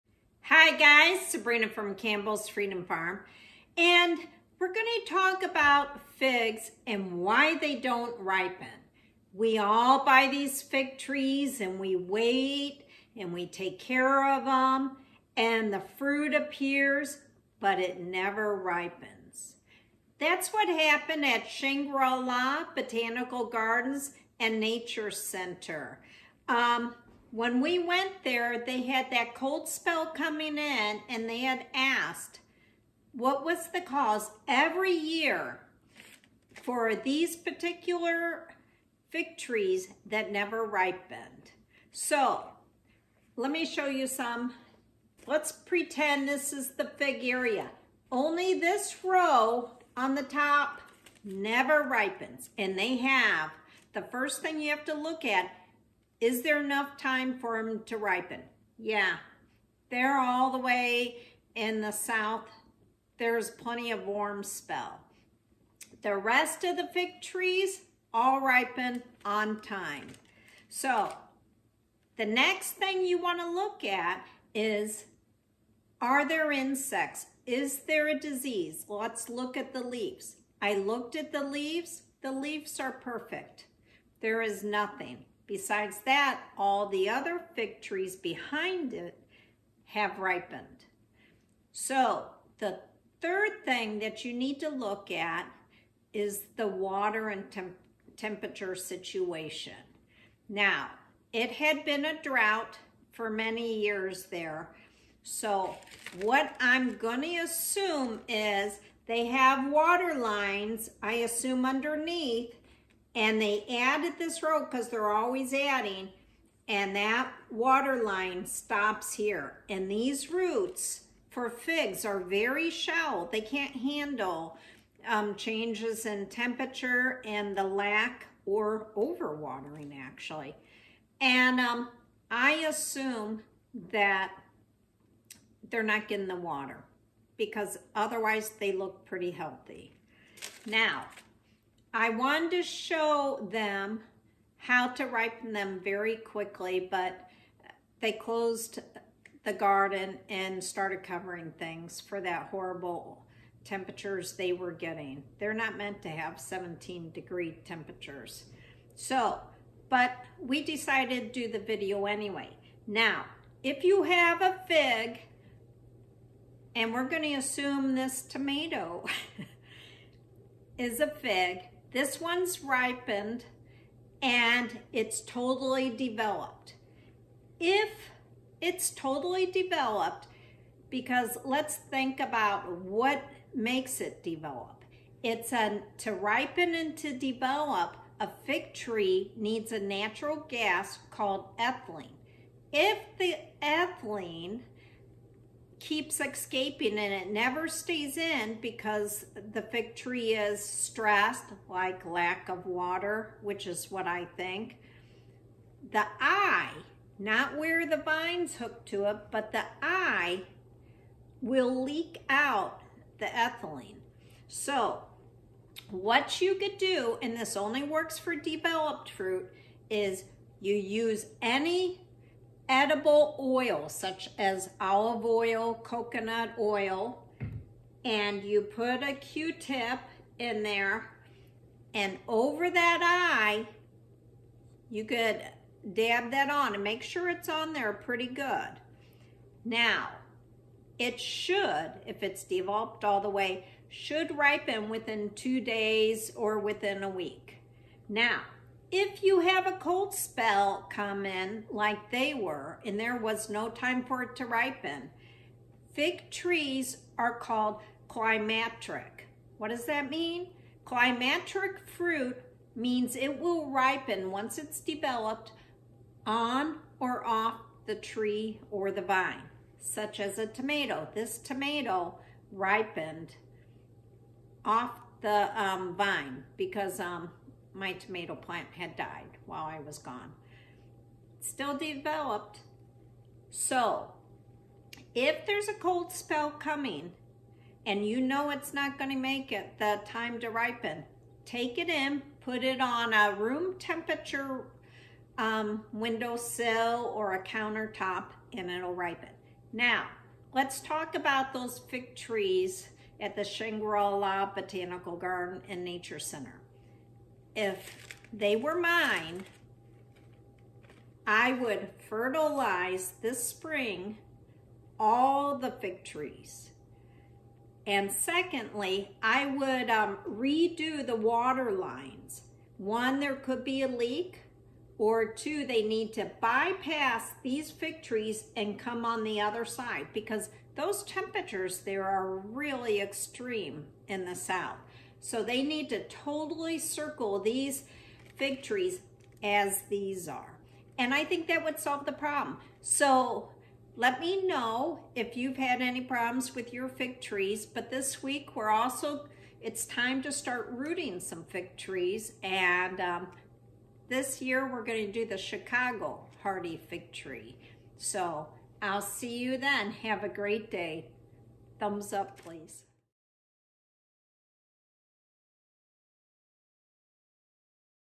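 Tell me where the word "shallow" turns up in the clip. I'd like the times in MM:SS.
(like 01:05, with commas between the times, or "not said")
02:02.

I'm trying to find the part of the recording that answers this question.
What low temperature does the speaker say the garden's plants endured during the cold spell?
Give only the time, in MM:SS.
02:36.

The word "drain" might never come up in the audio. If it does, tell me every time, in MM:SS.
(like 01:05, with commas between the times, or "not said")
not said.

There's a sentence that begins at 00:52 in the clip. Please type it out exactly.
And they have, the first thing you have to look at is there enough time for them to ripen?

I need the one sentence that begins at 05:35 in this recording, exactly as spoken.
So they need to totally circle these fig trees as these are.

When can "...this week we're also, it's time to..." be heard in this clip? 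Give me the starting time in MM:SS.
05:47.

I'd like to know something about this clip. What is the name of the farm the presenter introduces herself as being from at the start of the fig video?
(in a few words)
Campbell's Freedom Farm.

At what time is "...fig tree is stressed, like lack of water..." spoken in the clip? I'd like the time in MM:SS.
03:19.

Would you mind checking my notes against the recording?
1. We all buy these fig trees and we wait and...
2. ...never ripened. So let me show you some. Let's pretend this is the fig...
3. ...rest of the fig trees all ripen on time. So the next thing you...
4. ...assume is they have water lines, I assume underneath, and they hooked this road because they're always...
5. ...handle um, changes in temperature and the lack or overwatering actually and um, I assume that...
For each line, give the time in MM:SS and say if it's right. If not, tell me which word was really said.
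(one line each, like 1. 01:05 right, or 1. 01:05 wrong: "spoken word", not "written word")
1. 00:09 right
2. 00:40 right
3. 01:06 right
4. 01:47 wrong: "added", not "hooked"
5. 02:03 right.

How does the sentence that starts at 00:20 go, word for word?
That's what happened at Shangri-La Botanical Gardens and Nature Center.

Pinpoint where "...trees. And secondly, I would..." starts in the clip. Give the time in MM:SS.
05:16.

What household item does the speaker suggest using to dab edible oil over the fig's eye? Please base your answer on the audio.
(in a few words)
Q-tip.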